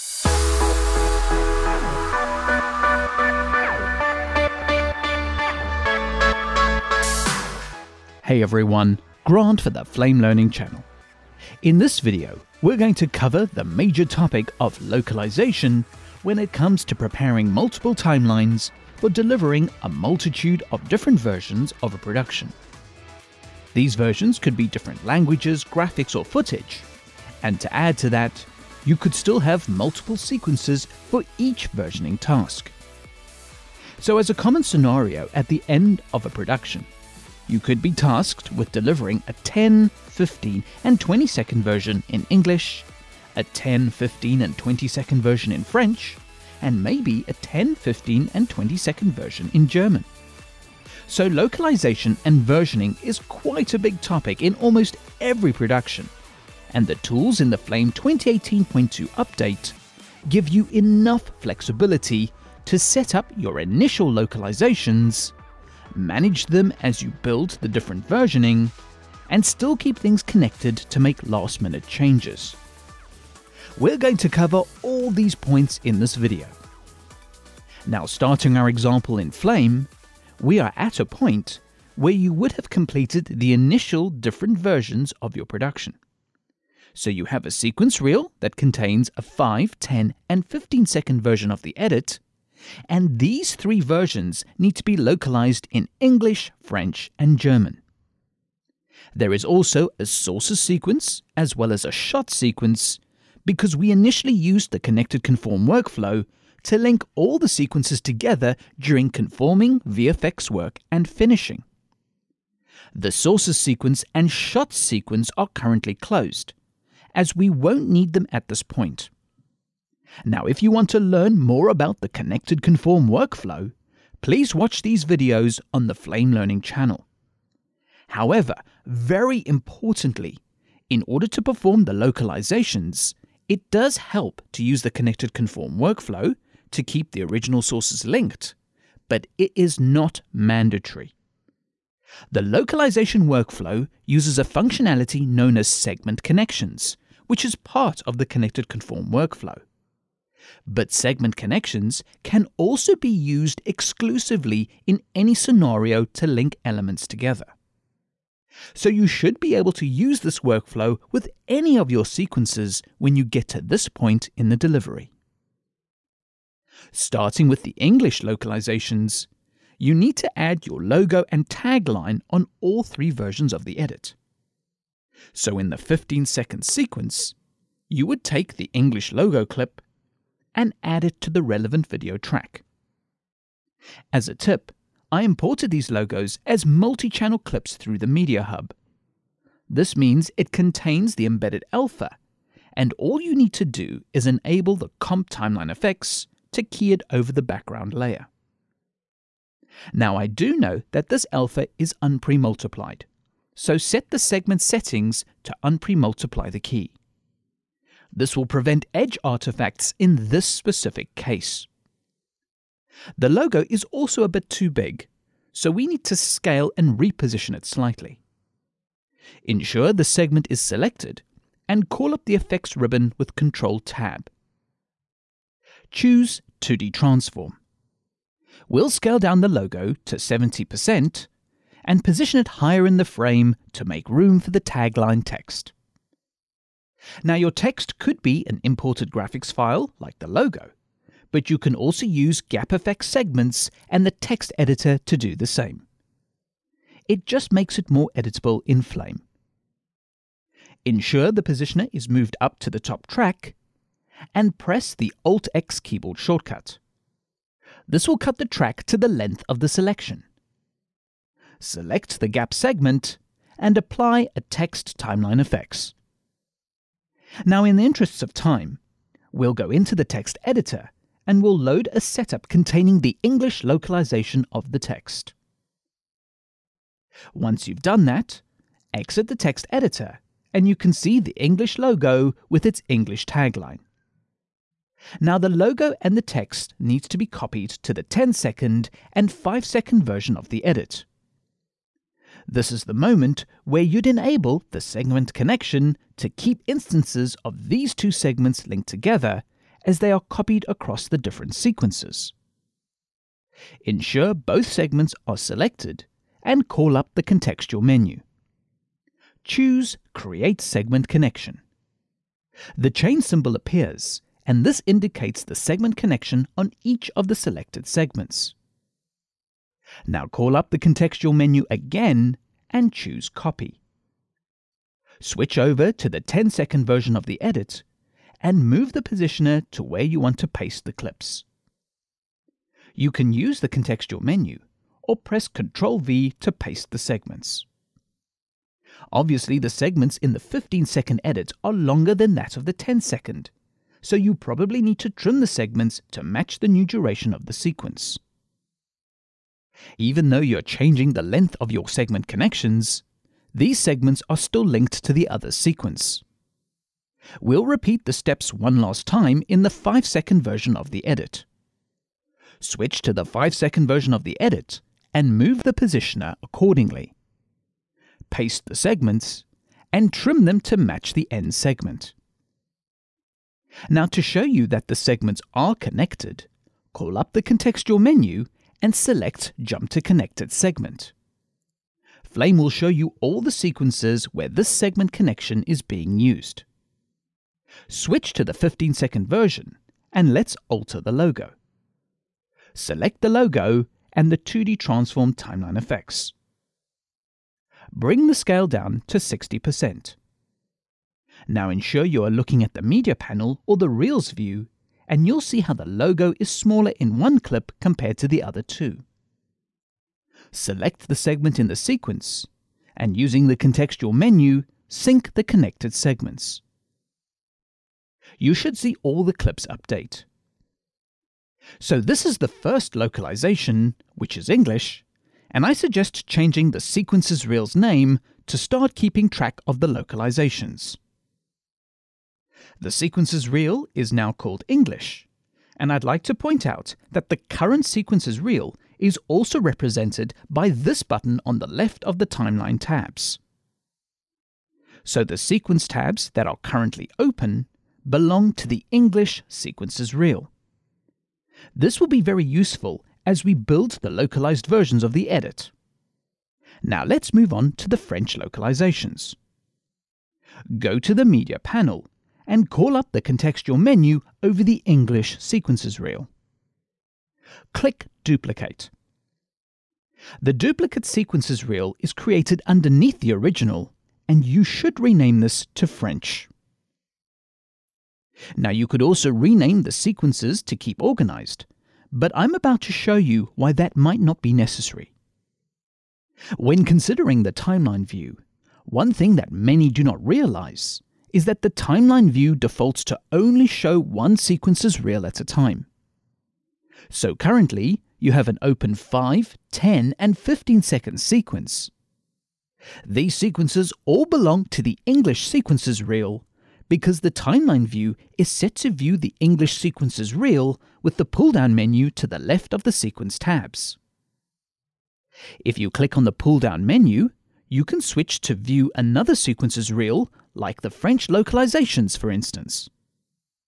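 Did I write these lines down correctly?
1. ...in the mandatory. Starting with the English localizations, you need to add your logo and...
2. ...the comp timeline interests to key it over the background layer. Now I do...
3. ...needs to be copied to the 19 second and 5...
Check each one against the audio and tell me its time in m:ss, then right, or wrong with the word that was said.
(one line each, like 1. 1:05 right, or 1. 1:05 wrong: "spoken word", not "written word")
1. 2:44 wrong: "delivery", not "mandatory"
2. 3:14 wrong: "effects", not "interests"
3. 4:46 wrong: "10", not "19".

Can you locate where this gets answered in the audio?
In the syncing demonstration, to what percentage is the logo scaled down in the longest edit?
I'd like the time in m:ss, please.
6:39.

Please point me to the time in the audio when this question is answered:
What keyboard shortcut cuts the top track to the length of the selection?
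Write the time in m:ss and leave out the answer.
4:15.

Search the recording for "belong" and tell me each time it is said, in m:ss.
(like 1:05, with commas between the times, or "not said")
7:28, 8:24.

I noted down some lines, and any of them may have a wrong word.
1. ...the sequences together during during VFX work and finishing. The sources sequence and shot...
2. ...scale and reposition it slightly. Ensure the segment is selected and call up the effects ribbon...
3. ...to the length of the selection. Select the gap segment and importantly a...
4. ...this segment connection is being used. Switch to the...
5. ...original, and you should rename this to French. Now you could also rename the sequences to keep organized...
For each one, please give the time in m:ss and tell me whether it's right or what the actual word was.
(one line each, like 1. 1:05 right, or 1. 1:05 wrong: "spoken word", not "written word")
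1. 1:47 wrong: "conforming", not "during"
2. 3:36 right
3. 4:18 wrong: "apply", not "importantly"
4. 6:24 right
5. 7:53 right.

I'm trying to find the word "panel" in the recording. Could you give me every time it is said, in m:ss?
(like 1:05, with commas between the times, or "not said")
6:43, 7:41.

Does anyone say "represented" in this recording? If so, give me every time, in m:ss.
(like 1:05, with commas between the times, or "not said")
7:19.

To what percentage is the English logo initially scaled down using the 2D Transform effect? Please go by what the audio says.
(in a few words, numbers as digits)
70%.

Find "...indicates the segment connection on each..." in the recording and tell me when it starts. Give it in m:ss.
5:14.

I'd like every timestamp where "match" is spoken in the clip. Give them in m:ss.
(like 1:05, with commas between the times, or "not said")
5:46, 6:10.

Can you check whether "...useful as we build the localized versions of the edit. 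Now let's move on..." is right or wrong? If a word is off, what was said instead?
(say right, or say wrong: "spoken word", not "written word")
right.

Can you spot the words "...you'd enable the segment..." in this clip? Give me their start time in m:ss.
4:53.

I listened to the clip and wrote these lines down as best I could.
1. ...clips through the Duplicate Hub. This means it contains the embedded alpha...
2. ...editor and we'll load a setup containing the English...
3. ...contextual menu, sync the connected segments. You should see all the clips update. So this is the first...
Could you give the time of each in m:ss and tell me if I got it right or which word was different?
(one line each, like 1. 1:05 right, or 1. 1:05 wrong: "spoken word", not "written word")
1. 3:07 wrong: "Media", not "Duplicate"
2. 4:30 right
3. 6:53 right.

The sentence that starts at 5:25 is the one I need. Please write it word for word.
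Switch over to the 10 second version of the edit and move the positioner to where you want to paste the clips.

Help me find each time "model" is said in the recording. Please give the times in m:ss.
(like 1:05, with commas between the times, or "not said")
not said.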